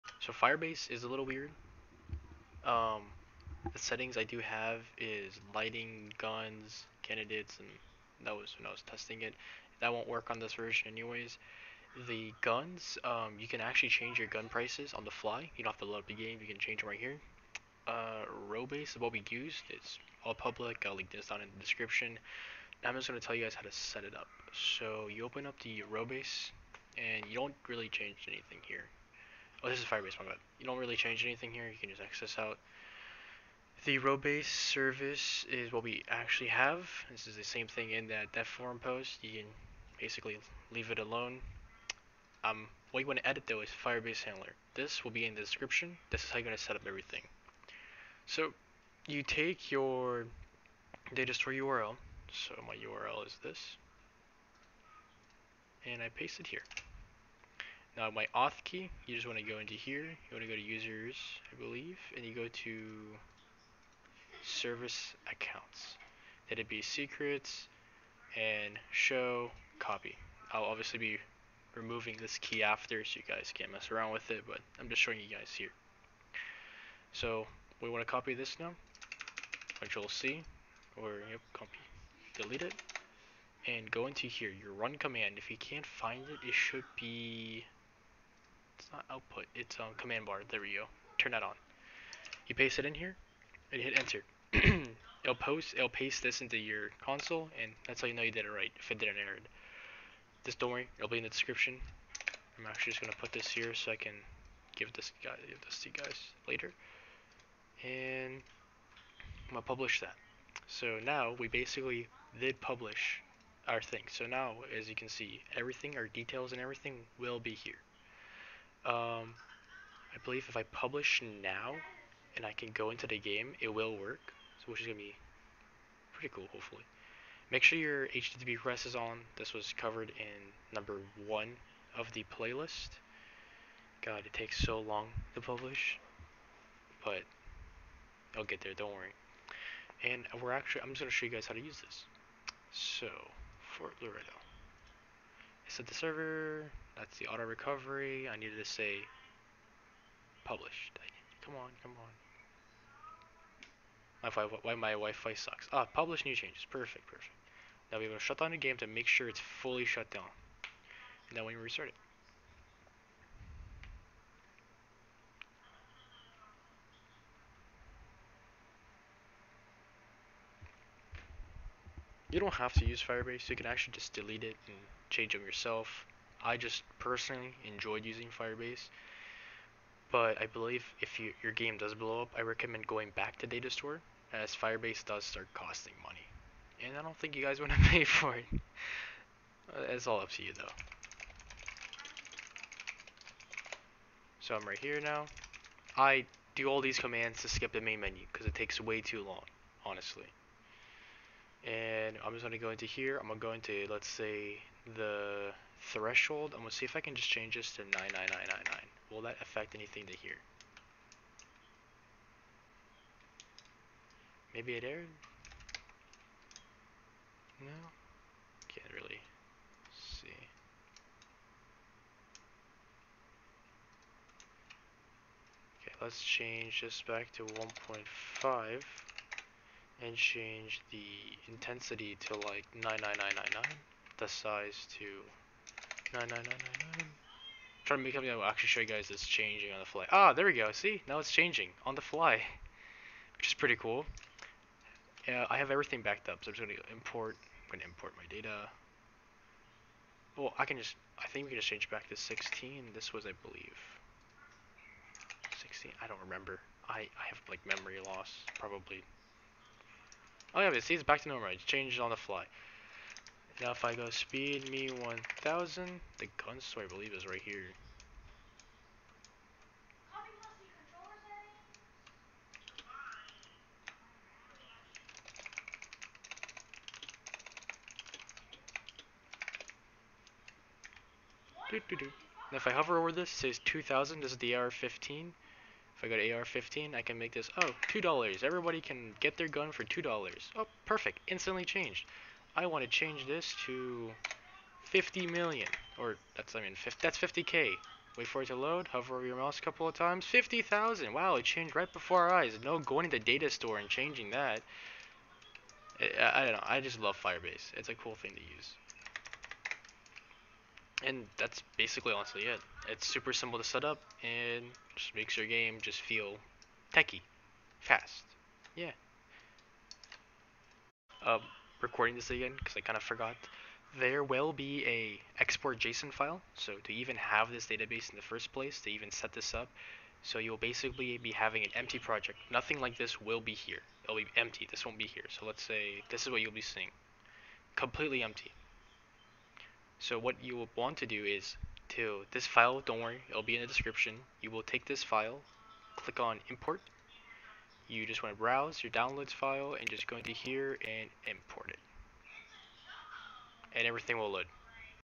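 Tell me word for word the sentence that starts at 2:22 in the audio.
So, Fort Loredo set the server.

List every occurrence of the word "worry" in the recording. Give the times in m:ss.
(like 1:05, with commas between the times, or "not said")
1:40, 2:18, 5:43.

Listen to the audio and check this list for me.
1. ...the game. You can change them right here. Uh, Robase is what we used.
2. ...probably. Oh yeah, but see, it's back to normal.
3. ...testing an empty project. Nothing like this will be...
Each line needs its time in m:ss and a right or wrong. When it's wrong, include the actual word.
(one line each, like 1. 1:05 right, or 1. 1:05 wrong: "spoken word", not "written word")
1. 0:16 right
2. 4:18 right
3. 5:31 wrong: "having", not "testing".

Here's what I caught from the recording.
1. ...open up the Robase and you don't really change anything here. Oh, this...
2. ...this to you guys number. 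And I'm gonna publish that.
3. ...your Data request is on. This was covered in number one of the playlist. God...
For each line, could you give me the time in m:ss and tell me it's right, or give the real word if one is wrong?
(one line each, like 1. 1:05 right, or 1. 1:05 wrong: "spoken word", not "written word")
1. 0:25 right
2. 1:45 wrong: "later", not "number"
3. 2:07 wrong: "HTTP", not "Data".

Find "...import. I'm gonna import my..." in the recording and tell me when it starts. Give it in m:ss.
4:06.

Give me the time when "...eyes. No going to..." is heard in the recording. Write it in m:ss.
5:02.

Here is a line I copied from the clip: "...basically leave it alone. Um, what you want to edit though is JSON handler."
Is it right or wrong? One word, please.
wrong.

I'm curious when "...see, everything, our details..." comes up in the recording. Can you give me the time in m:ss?
1:55.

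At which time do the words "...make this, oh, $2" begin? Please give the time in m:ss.
4:47.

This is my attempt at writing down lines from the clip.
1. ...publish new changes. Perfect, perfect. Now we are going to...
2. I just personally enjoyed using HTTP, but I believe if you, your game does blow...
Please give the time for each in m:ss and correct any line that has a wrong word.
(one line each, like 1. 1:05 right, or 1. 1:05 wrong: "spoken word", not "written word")
1. 2:35 right
2. 2:56 wrong: "Firebase", not "HTTP".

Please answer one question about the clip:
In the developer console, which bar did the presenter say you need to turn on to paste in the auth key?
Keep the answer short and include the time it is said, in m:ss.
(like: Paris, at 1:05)
command bar, at 1:29.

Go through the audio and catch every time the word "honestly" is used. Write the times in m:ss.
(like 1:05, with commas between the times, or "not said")
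3:19, 5:12.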